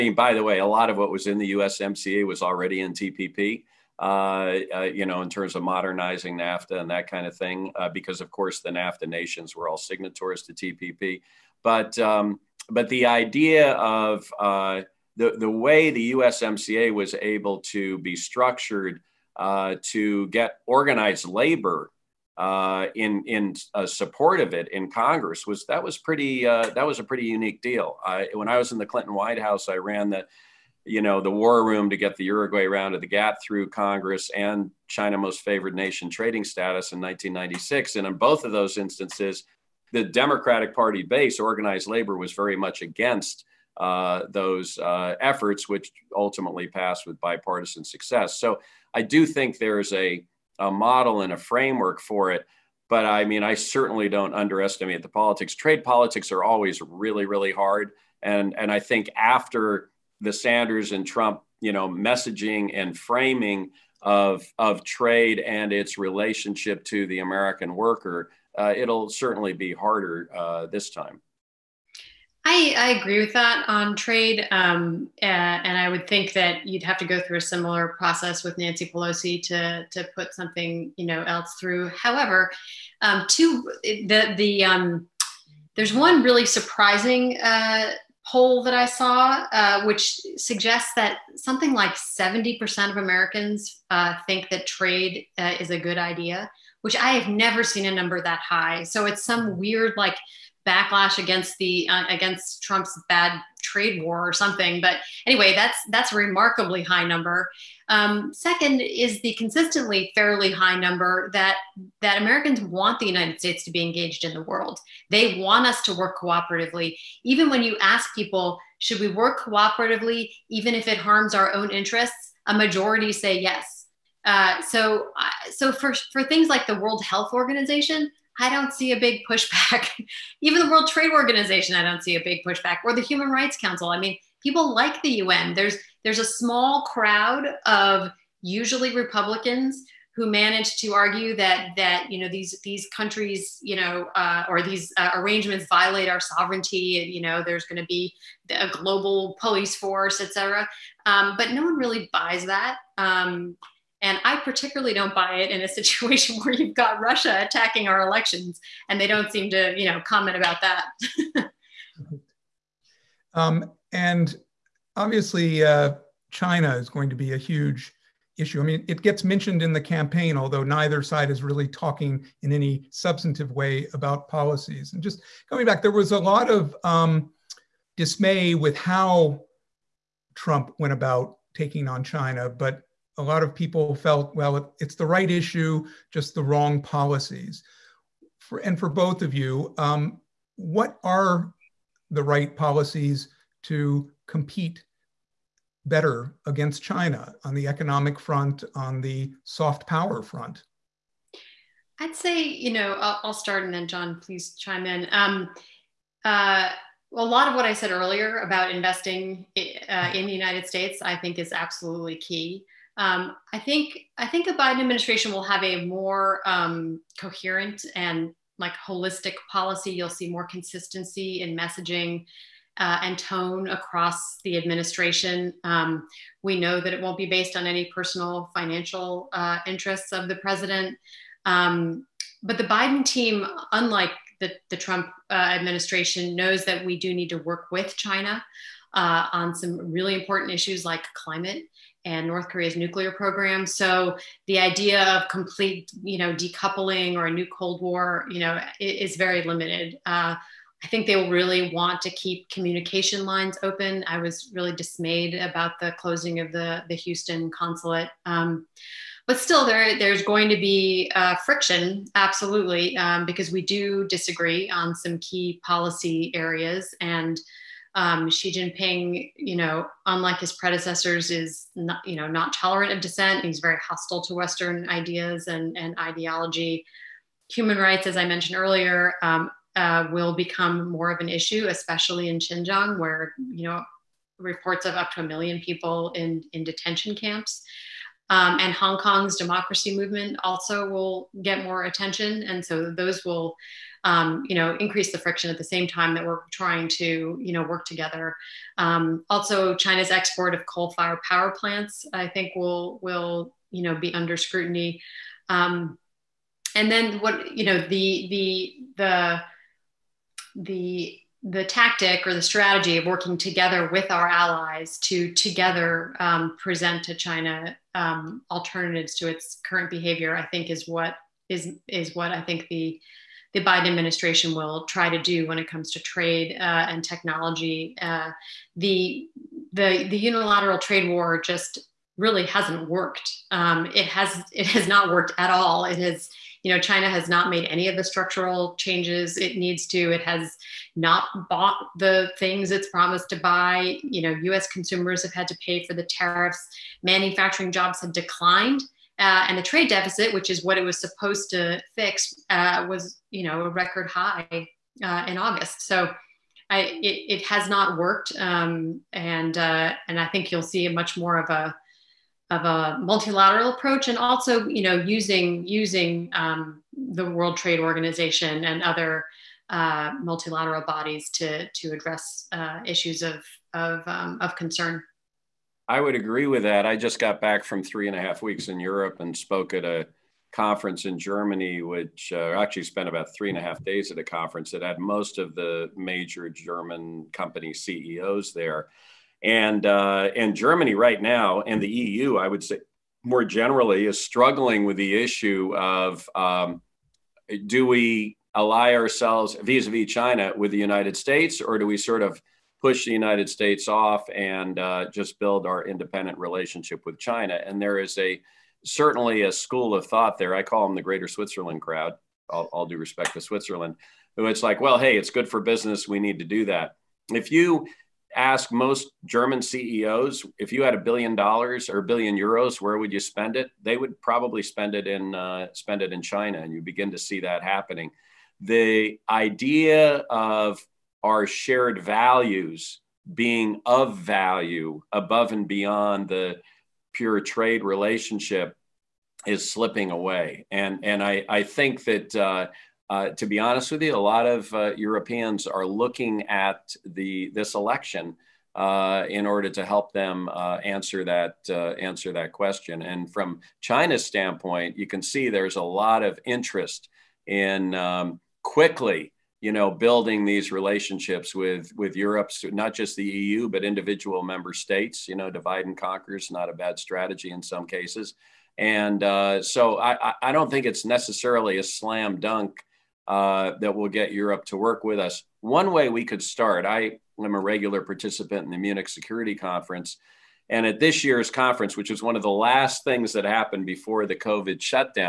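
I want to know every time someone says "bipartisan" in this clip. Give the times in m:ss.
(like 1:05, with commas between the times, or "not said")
0:47.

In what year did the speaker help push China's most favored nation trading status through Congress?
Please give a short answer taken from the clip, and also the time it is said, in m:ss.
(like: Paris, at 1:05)
1996, at 0:36.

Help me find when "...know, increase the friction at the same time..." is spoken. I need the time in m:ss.
4:54.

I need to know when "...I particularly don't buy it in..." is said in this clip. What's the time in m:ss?
2:34.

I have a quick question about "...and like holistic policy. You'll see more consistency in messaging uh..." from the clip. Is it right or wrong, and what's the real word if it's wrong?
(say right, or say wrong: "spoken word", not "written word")
right.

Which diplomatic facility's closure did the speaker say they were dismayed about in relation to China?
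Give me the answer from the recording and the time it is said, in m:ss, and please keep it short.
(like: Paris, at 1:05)
Houston consulate, at 4:16.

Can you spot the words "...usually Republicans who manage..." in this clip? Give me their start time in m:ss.
2:18.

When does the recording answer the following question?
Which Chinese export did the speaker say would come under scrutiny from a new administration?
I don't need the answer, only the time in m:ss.
5:00.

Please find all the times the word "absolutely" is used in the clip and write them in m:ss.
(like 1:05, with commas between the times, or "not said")
3:31, 4:22.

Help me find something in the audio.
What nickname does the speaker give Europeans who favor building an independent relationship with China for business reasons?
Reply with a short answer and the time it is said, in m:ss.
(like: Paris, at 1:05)
Greater Switzerland crowd, at 6:51.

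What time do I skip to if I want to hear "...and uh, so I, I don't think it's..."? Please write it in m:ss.
7:48.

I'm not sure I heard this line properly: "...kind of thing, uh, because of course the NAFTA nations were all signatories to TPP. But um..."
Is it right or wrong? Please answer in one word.
right.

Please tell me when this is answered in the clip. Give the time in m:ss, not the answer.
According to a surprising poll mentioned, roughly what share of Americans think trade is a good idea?
1:31.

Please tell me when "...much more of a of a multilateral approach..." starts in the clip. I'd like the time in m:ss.
6:00.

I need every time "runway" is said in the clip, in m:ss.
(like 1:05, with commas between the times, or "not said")
not said.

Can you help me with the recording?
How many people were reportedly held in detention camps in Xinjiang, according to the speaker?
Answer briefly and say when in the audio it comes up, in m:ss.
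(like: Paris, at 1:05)
a million, at 4:45.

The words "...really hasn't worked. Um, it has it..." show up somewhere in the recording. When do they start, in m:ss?
5:32.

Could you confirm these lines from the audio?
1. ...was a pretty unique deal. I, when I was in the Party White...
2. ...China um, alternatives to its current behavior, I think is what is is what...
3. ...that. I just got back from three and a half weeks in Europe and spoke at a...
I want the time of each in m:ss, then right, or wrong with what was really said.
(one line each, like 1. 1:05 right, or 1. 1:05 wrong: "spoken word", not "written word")
1. 0:26 wrong: "Clinton", not "Party"
2. 5:17 right
3. 6:16 right.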